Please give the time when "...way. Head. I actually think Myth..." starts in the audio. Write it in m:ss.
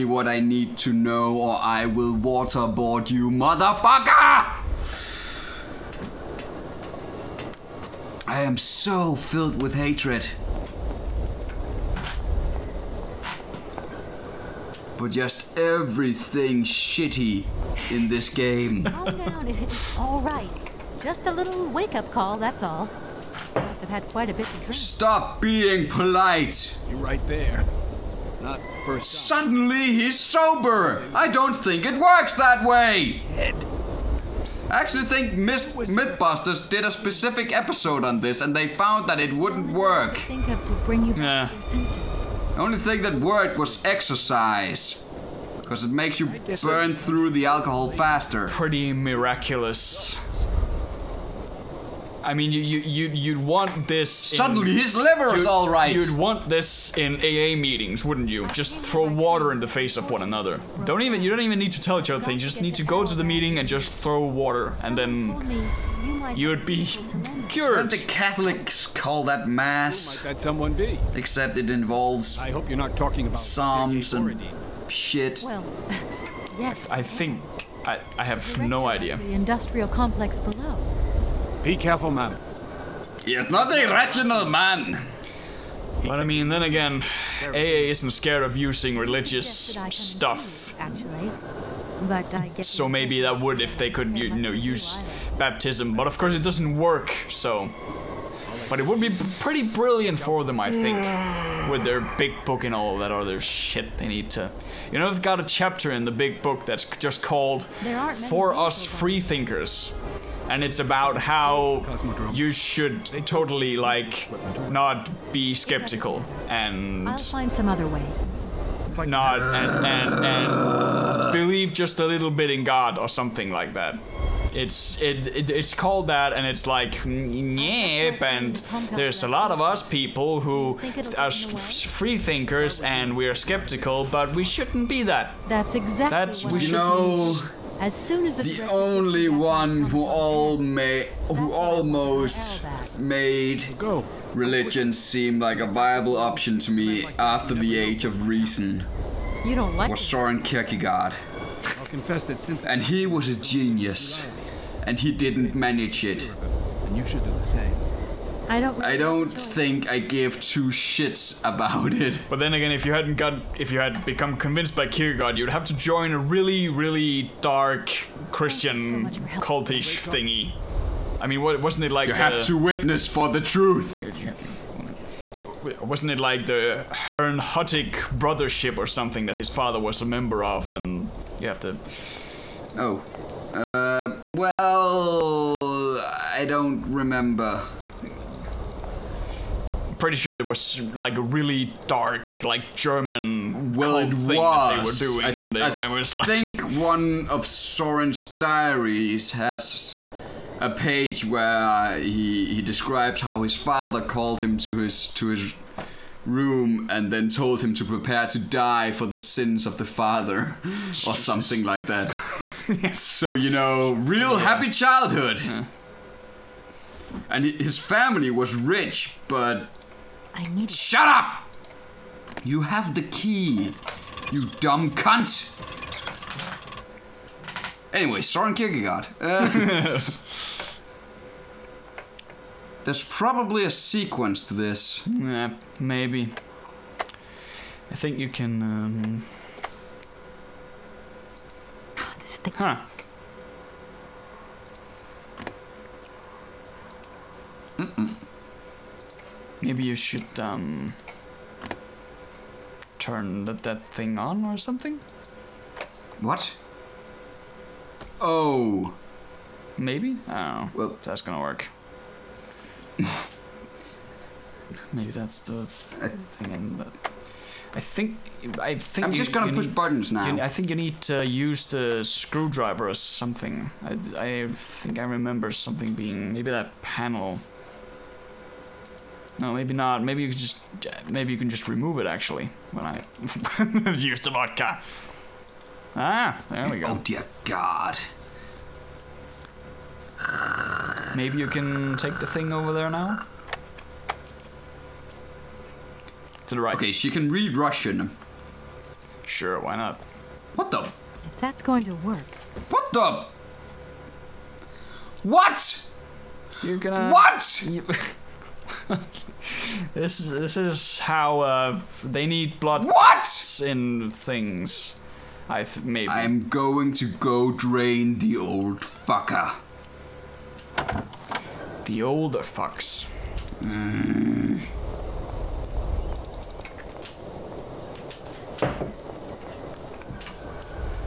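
0:32.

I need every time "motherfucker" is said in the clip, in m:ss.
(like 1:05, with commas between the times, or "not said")
0:03.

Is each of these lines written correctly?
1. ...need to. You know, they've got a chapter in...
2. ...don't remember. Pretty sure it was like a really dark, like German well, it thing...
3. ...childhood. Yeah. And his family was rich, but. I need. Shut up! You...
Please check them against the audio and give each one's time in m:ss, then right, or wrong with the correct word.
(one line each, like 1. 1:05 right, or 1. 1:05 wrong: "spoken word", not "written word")
1. 1:44 right
2. 3:06 right
3. 3:34 right.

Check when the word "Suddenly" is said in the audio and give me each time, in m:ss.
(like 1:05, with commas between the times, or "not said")
0:29, 0:54.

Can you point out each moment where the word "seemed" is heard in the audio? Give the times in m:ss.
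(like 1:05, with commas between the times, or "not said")
2:24.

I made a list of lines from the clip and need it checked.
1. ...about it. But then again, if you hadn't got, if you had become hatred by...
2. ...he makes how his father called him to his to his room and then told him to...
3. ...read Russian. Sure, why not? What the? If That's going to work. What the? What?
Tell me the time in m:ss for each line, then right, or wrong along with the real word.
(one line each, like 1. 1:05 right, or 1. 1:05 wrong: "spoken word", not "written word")
1. 2:41 wrong: "convinced", not "hatred"
2. 3:22 wrong: "describes", not "makes"
3. 4:57 right.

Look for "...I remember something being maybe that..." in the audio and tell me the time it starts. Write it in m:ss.
4:34.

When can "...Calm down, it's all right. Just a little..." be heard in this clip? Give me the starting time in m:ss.
0:18.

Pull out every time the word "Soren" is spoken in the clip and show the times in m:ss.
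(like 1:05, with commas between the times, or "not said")
2:30, 3:17, 3:48.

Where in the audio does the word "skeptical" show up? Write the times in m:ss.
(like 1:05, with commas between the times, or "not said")
1:55, 2:13.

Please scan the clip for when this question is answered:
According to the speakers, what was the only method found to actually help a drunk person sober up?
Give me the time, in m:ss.
0:43.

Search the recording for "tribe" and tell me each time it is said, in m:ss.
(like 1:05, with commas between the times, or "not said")
not said.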